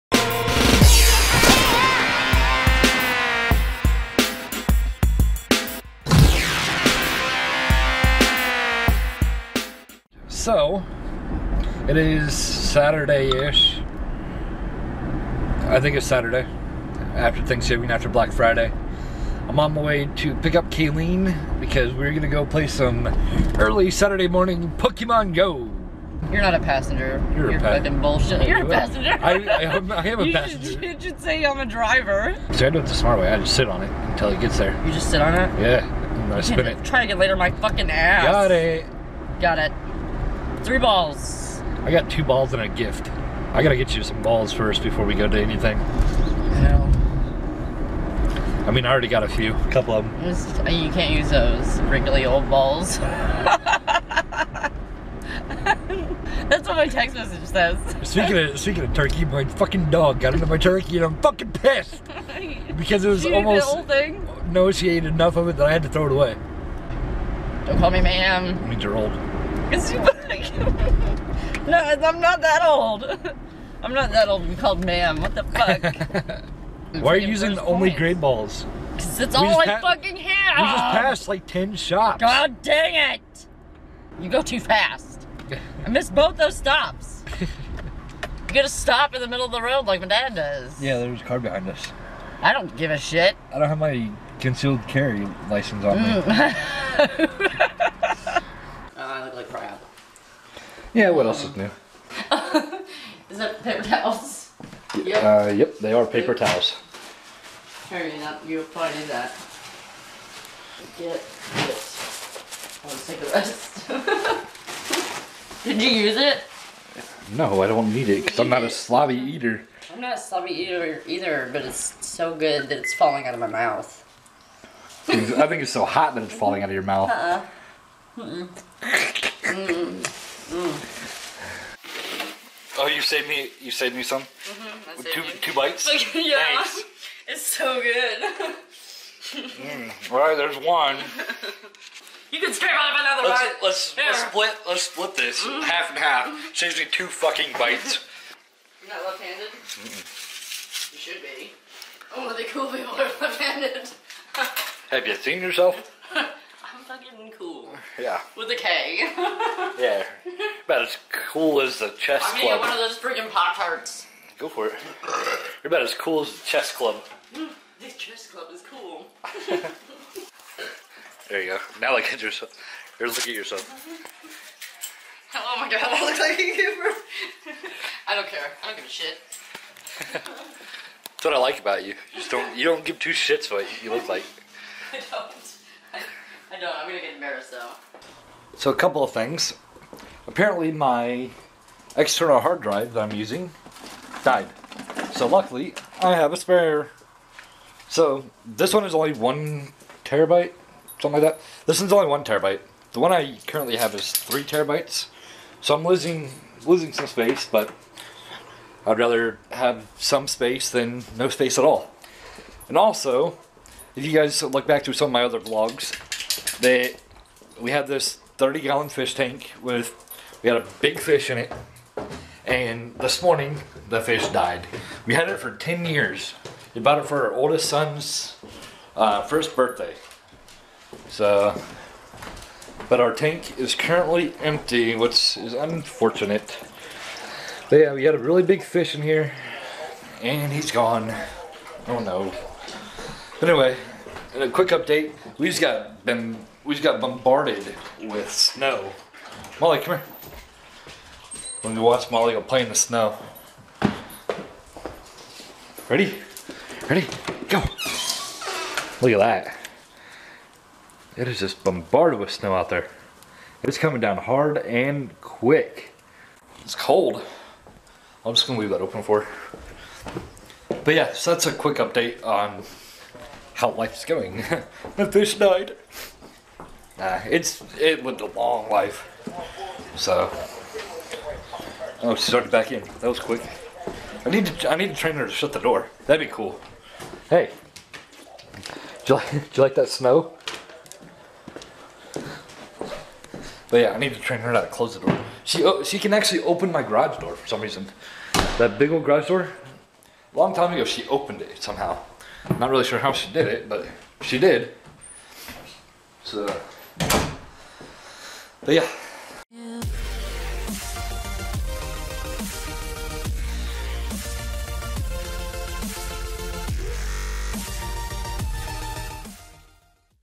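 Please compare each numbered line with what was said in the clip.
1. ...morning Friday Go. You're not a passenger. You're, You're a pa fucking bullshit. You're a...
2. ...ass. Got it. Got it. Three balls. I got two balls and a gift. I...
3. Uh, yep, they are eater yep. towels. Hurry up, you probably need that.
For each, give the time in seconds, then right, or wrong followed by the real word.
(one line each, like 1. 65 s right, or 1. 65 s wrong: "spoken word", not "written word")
1. 24 s wrong: "Pokemon", not "Friday"
2. 37 s right
3. 105 s wrong: "paper", not "eater".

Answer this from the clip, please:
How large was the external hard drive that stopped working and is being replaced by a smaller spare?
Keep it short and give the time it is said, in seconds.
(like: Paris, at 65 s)
3 terabytes, at 204 s.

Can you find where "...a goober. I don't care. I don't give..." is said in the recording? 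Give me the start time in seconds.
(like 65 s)
176 s.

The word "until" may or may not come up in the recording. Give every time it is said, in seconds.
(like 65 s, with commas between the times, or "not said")
34 s.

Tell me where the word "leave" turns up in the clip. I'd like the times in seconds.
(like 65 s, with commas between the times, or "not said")
268 s.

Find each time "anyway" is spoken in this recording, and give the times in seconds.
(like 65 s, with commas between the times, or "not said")
243 s.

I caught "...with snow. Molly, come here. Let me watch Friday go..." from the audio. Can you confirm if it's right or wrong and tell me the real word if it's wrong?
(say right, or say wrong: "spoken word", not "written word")
wrong: "Molly", not "Friday".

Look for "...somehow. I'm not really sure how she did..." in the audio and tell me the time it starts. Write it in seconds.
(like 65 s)
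301 s.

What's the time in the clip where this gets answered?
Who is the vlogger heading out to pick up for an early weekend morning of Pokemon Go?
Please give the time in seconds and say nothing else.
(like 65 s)
20 s.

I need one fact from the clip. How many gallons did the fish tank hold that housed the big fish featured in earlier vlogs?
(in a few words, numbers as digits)
30.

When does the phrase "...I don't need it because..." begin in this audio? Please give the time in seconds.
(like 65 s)
117 s.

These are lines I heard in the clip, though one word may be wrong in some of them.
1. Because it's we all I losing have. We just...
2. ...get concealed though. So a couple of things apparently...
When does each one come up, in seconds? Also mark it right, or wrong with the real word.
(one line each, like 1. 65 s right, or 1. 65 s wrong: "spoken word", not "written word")
1. 78 s wrong: "fucking", not "losing"
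2. 186 s wrong: "embarrassed", not "concealed".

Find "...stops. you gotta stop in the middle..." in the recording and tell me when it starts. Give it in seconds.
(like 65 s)
86 s.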